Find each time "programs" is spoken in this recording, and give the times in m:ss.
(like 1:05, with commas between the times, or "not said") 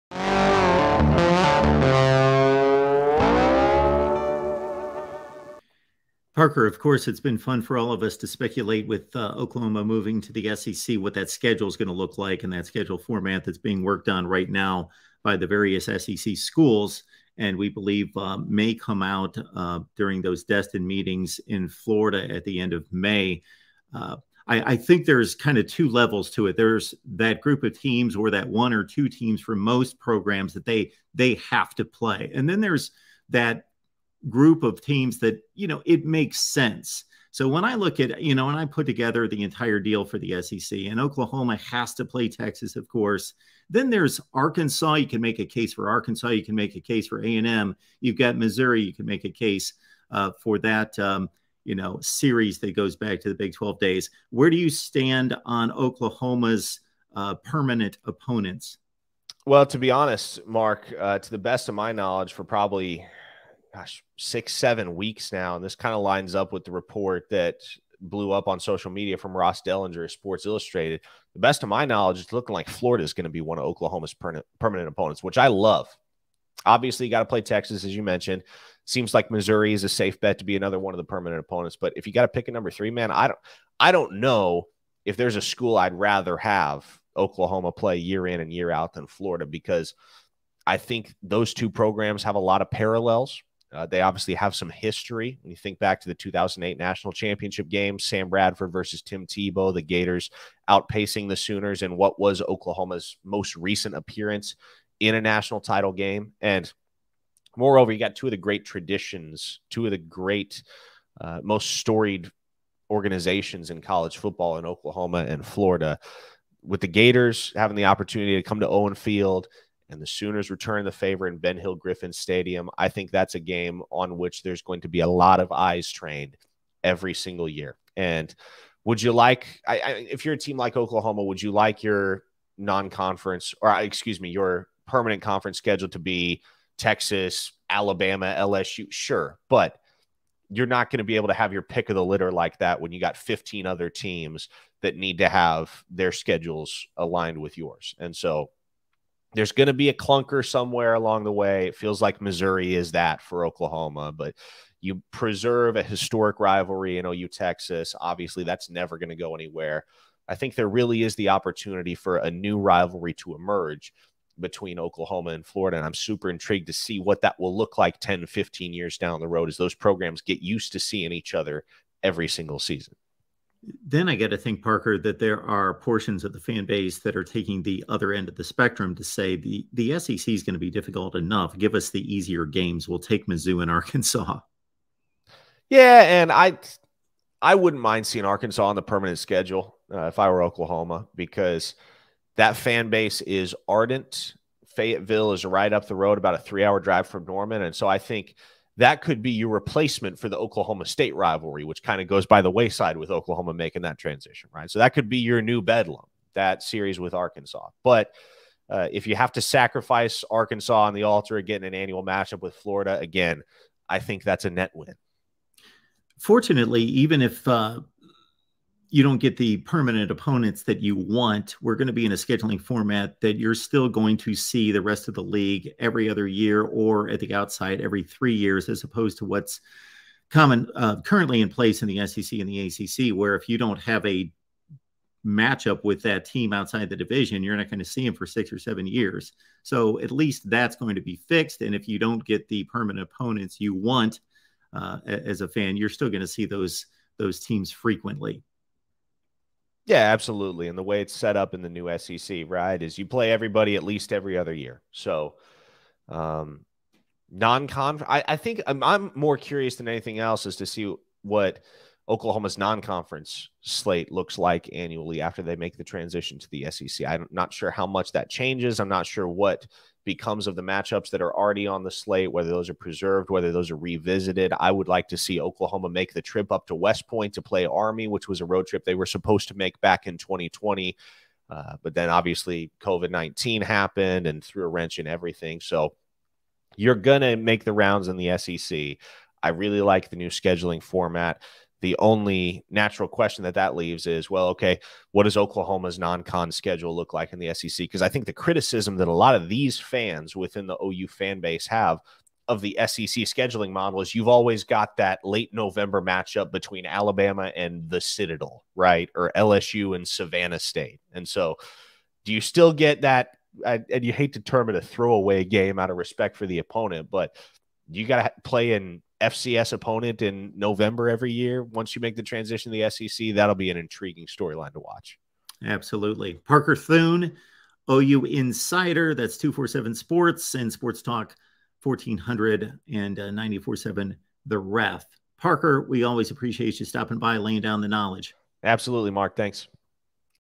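0:29, 1:31, 2:49.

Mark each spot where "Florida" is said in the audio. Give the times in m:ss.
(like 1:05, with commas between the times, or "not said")
0:21, 1:12, 1:29, 1:55, 2:45, 3:32.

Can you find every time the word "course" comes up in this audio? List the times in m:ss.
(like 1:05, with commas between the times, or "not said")
0:06, 0:42.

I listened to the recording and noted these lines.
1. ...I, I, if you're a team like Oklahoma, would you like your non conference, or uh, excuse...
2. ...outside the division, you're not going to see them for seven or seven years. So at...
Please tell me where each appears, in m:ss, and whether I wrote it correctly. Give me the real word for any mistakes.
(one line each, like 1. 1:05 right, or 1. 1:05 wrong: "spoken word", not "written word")
1. 2:09 right
2. 3:56 wrong: "six", not "seven".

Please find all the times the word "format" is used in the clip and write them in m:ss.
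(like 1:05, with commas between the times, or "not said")
0:12, 3:42, 4:50.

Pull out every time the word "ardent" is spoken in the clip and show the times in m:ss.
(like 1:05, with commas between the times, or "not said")
3:13.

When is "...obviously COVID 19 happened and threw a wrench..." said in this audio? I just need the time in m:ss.
4:42.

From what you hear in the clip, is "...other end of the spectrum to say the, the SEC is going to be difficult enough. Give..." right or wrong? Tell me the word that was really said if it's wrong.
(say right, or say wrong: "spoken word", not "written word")
right.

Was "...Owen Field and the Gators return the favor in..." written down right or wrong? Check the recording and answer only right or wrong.
wrong.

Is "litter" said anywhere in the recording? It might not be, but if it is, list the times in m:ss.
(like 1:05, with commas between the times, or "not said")
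2:22.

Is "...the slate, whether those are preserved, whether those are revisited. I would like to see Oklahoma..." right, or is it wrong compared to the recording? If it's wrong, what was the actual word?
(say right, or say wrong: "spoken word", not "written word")
right.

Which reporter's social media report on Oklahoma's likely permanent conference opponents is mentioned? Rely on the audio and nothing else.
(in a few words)
Ross Dellenger.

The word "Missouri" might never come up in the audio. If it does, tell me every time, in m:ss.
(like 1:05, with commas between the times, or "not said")
0:48, 1:19, 2:32.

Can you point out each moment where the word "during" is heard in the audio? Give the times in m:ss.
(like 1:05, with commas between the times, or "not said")
0:19.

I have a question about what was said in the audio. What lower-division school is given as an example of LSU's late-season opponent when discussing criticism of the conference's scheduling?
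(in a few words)
Savannah State.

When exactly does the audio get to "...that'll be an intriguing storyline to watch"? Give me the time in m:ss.
5:23.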